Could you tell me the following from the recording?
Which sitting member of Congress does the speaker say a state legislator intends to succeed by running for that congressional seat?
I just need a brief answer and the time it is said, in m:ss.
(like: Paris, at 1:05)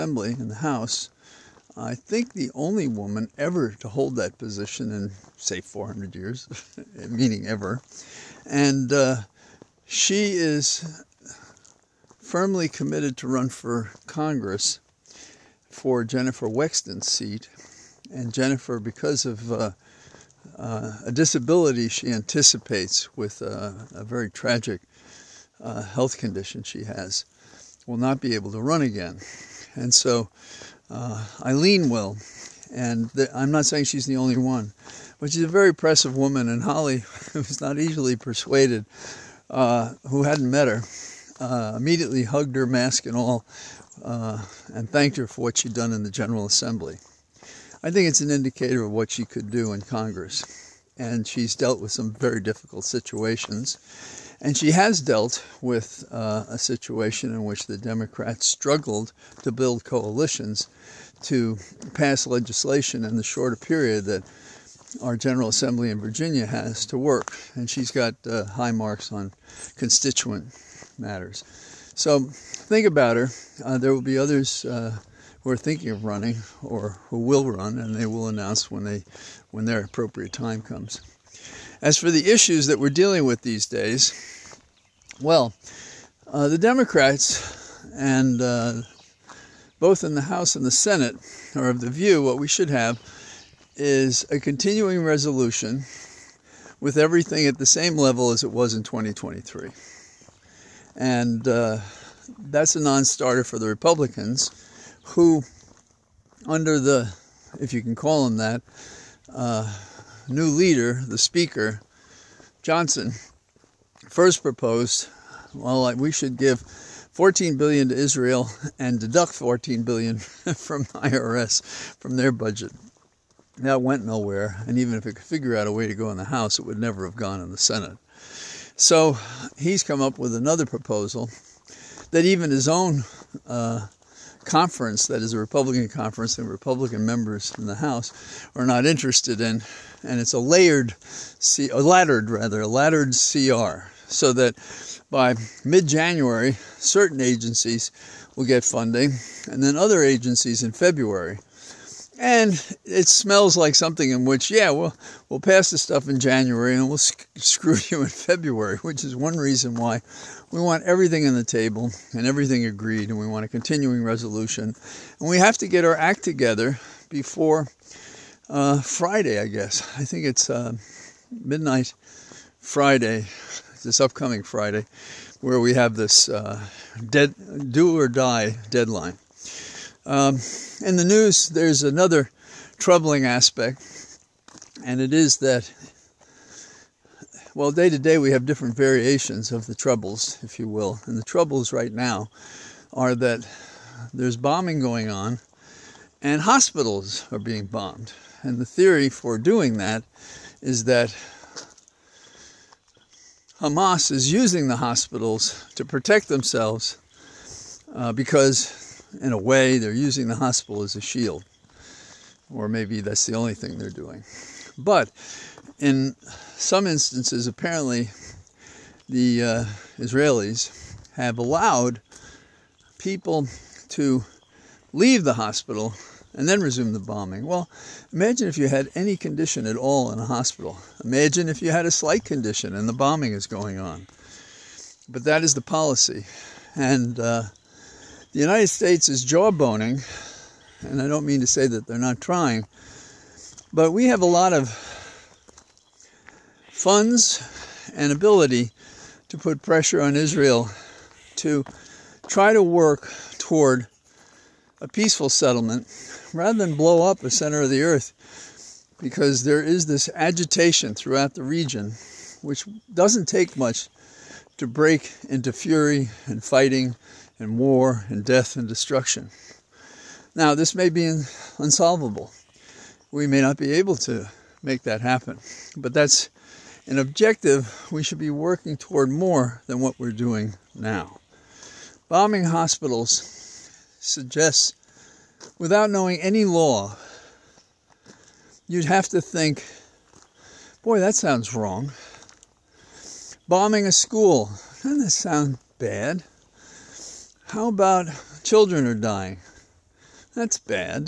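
Jennifer Wexton, at 0:16.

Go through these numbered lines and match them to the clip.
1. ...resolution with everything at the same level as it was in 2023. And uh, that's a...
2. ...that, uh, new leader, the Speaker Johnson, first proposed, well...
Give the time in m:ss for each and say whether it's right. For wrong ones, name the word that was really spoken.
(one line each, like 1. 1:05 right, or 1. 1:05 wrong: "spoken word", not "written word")
1. 1:35 right
2. 1:48 right.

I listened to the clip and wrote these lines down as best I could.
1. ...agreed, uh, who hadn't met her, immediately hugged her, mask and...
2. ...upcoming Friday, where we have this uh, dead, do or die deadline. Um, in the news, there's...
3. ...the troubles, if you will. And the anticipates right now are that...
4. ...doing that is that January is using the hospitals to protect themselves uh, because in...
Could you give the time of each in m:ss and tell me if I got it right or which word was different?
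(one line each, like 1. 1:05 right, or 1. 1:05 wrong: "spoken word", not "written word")
1. 0:38 wrong: "persuaded", not "agreed"
2. 2:53 right
3. 3:09 wrong: "troubles", not "anticipates"
4. 3:19 wrong: "Hamas", not "January".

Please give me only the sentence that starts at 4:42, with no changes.
Bombing hospitals suggests, without knowing any law, you'd have to think, boy, that sounds wrong.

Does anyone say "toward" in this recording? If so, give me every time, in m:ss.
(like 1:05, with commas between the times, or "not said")
4:13, 4:38.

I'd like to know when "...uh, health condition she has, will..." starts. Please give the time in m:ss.
0:25.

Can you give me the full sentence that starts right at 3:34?
But in some instances, apparently, the uh, Israelis have allowed people to leave the hospital and then resume the bombing.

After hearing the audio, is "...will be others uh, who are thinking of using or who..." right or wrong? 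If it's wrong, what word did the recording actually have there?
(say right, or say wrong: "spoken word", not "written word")
wrong: "running", not "using".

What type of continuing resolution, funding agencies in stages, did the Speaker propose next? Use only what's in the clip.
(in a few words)
laddered CR.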